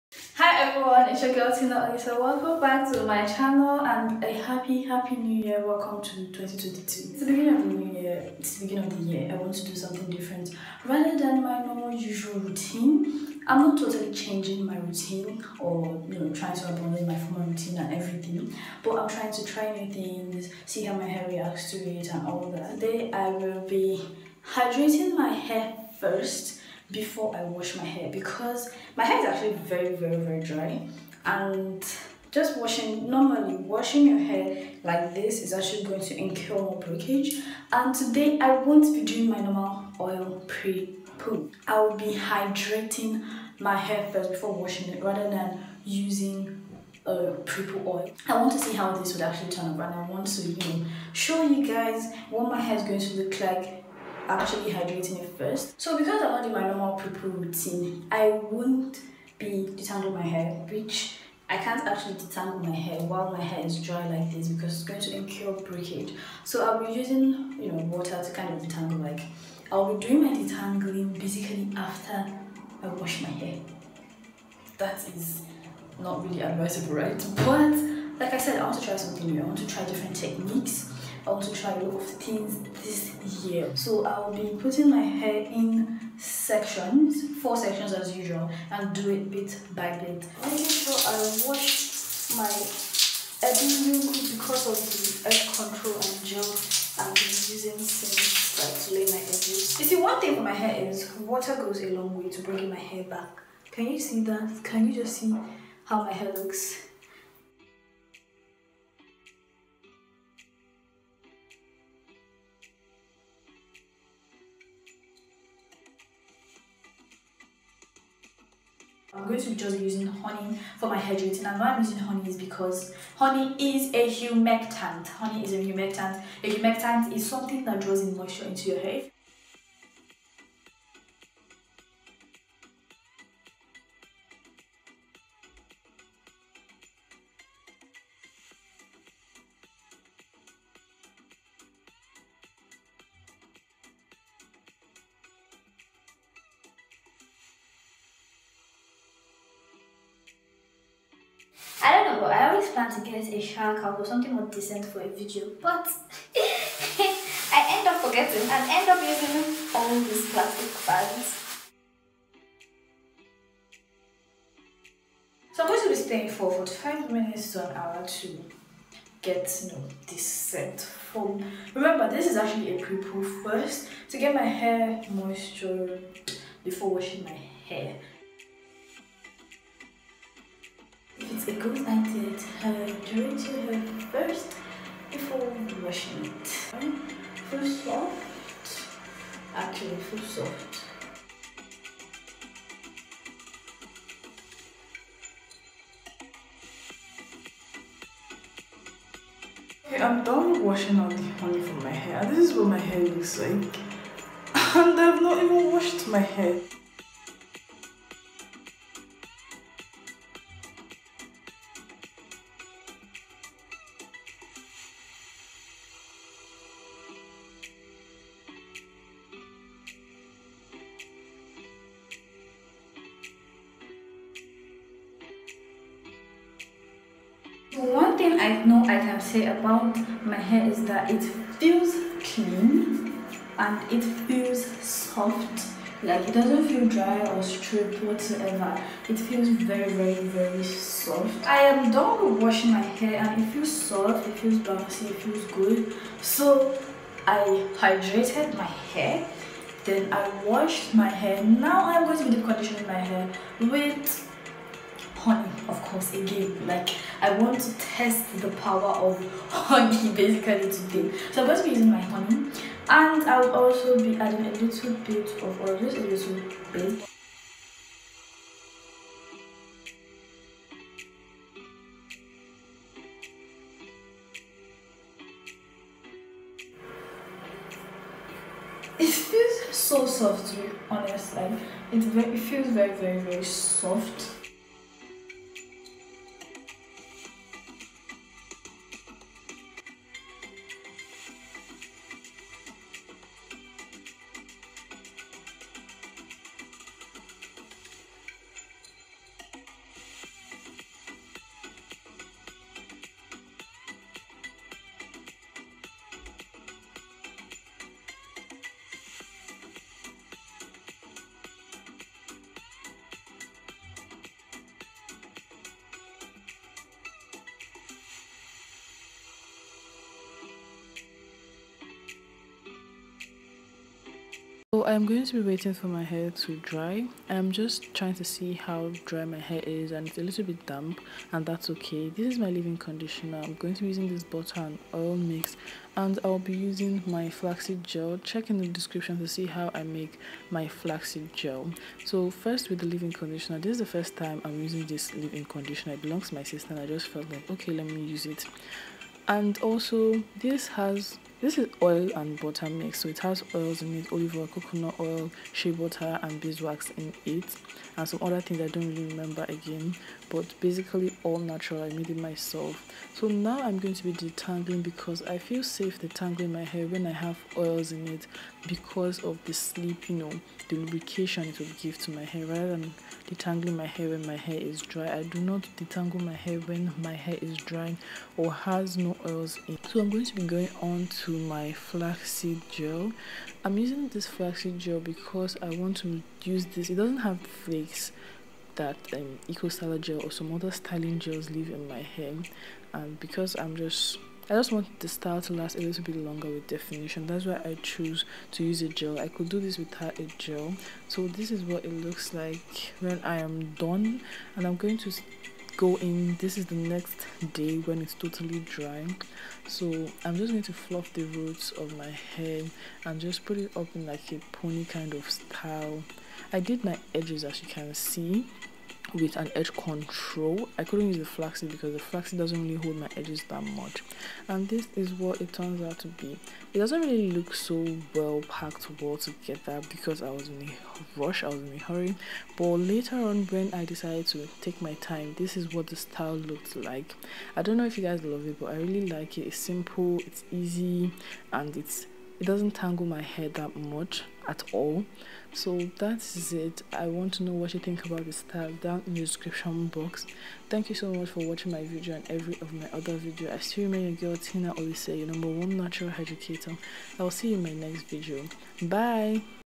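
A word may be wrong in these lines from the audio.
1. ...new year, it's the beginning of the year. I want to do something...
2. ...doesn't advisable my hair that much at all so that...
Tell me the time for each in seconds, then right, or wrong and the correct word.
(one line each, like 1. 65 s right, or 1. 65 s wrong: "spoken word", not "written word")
1. 7 s right
2. 442 s wrong: "tangle", not "advisable".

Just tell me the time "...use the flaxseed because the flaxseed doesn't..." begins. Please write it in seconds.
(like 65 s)
421 s.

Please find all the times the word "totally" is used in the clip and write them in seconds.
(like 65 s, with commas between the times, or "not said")
13 s, 408 s.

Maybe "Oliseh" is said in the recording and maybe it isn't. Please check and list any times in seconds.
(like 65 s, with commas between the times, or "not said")
1 s, 454 s.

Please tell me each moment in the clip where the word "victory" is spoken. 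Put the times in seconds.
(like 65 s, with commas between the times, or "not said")
not said.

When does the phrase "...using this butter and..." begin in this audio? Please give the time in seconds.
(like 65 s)
333 s.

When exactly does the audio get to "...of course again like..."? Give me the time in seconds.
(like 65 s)
255 s.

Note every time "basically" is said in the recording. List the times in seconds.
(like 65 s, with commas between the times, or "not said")
71 s, 260 s, 360 s.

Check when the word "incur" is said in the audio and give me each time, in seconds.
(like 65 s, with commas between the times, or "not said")
36 s, 65 s.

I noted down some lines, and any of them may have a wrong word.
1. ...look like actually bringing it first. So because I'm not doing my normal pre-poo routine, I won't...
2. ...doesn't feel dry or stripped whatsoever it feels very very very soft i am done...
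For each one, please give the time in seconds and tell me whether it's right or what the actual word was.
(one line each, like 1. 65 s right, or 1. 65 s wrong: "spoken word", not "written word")
1. 53 s wrong: "hydrating", not "bringing"
2. 236 s right.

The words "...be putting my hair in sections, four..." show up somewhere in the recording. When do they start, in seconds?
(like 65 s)
84 s.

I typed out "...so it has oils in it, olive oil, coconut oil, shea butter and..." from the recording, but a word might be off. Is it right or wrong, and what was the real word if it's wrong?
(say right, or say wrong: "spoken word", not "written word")
right.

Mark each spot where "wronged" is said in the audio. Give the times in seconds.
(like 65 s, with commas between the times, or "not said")
not said.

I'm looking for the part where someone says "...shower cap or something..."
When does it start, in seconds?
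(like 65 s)
153 s.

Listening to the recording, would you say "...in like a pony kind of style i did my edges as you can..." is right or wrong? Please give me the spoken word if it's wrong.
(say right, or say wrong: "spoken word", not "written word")
right.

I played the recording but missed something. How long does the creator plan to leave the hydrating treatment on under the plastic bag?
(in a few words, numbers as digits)
45 minutes to an hour.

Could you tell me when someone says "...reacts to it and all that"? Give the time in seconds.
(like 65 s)
21 s.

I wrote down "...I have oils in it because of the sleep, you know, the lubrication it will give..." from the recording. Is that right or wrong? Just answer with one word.
right.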